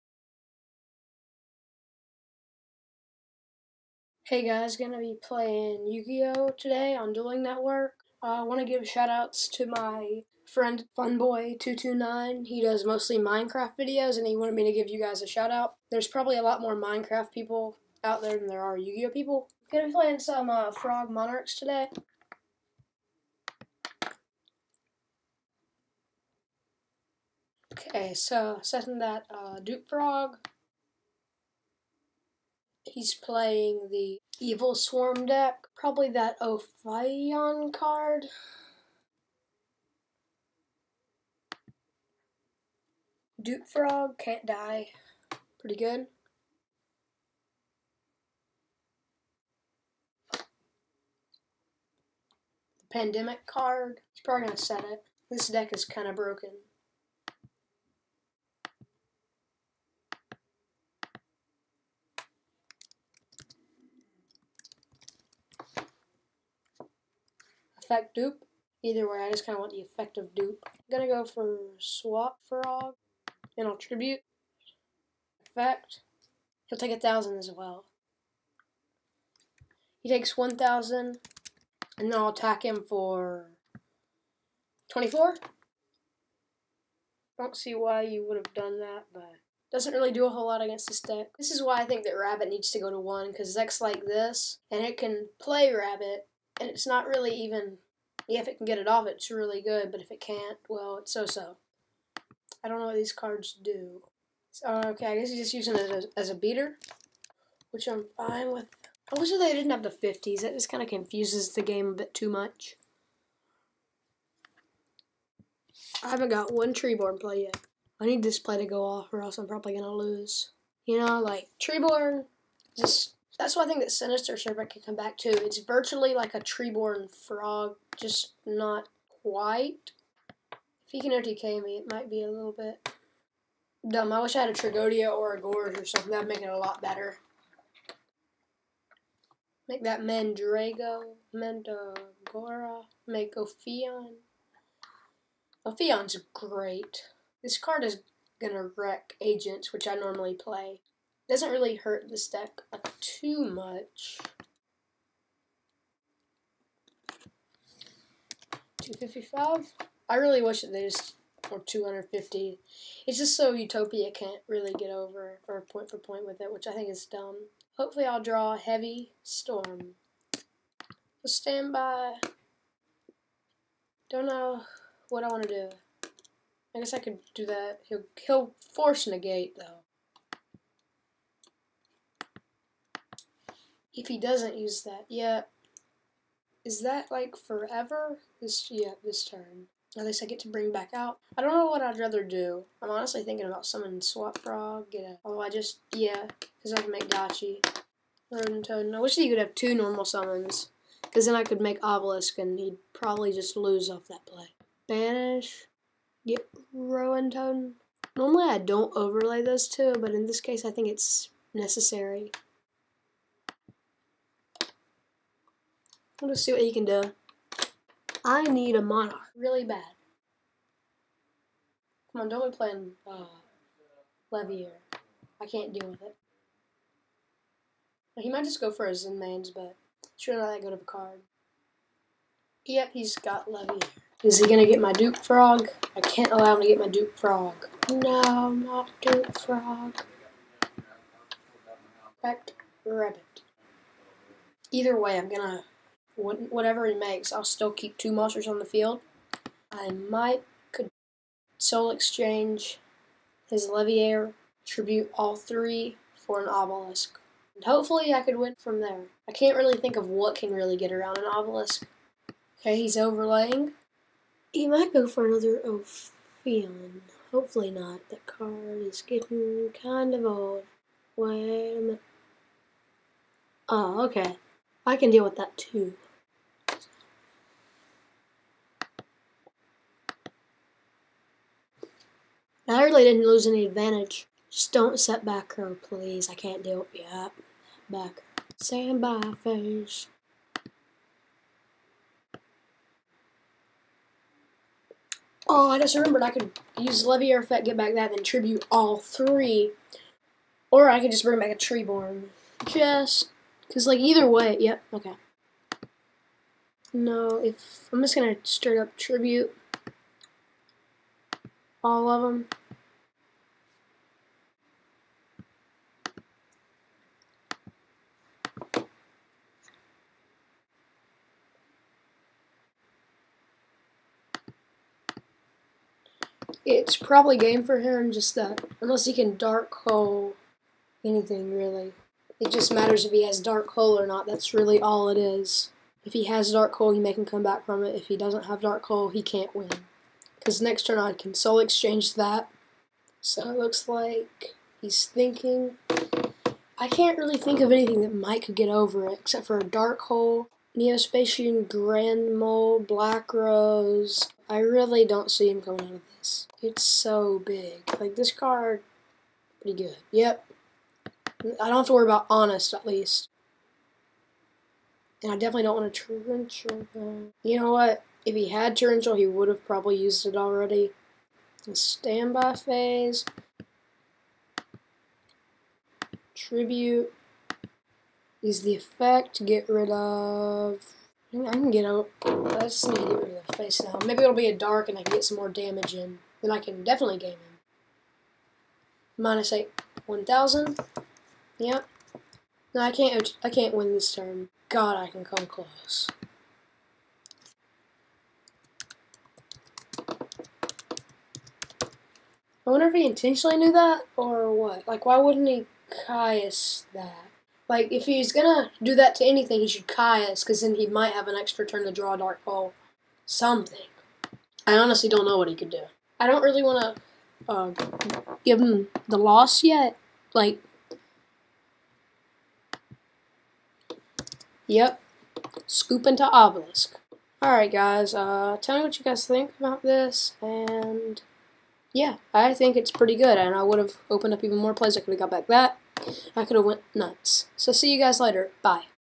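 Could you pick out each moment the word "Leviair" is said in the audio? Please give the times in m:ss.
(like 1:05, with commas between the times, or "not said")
3:44, 4:13, 4:57.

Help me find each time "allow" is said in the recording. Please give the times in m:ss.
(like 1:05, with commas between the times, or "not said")
3:56.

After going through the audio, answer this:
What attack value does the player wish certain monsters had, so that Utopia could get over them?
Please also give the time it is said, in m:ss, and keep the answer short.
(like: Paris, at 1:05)
250, at 2:41.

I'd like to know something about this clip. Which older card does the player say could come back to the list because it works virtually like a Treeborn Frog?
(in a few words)
Sinister Serpent.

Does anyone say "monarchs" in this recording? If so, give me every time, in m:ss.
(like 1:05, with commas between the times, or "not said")
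0:21, 3:38.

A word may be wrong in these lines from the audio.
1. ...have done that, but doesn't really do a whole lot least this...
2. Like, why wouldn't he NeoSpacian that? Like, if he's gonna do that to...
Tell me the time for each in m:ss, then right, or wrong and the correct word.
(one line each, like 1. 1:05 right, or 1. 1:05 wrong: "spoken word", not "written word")
1. 1:28 wrong: "against", not "least"
2. 6:44 wrong: "Caius", not "NeoSpacian".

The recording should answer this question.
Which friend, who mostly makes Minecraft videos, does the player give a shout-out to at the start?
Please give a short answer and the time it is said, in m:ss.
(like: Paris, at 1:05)
Funboy229, at 0:10.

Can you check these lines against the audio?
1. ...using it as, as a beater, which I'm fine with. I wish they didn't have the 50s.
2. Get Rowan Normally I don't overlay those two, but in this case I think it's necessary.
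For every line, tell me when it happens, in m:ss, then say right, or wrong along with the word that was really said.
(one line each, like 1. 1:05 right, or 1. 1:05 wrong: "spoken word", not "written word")
1. 1:45 right
2. 3:26 right.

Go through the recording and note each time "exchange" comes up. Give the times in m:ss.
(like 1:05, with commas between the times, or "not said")
4:11, 5:41.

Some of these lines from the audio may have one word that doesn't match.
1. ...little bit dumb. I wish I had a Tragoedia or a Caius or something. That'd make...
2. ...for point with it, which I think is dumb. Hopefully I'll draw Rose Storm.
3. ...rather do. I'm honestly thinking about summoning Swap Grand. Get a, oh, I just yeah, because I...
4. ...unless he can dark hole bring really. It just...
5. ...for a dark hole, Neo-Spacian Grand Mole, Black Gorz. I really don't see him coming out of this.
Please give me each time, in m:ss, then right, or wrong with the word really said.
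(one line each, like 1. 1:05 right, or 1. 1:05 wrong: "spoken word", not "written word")
1. 2:12 wrong: "Gorz", not "Caius"
2. 2:45 wrong: "Heavy", not "Rose"
3. 3:11 wrong: "Frog", not "Grand"
4. 5:28 wrong: "anything", not "bring"
5. 5:49 wrong: "Rose", not "Gorz".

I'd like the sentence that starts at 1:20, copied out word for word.
He takes 1,000, and then I'll attack him for 24.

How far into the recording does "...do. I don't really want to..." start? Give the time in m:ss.
6:55.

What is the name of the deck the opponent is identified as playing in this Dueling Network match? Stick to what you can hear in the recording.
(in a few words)
Evilswarm.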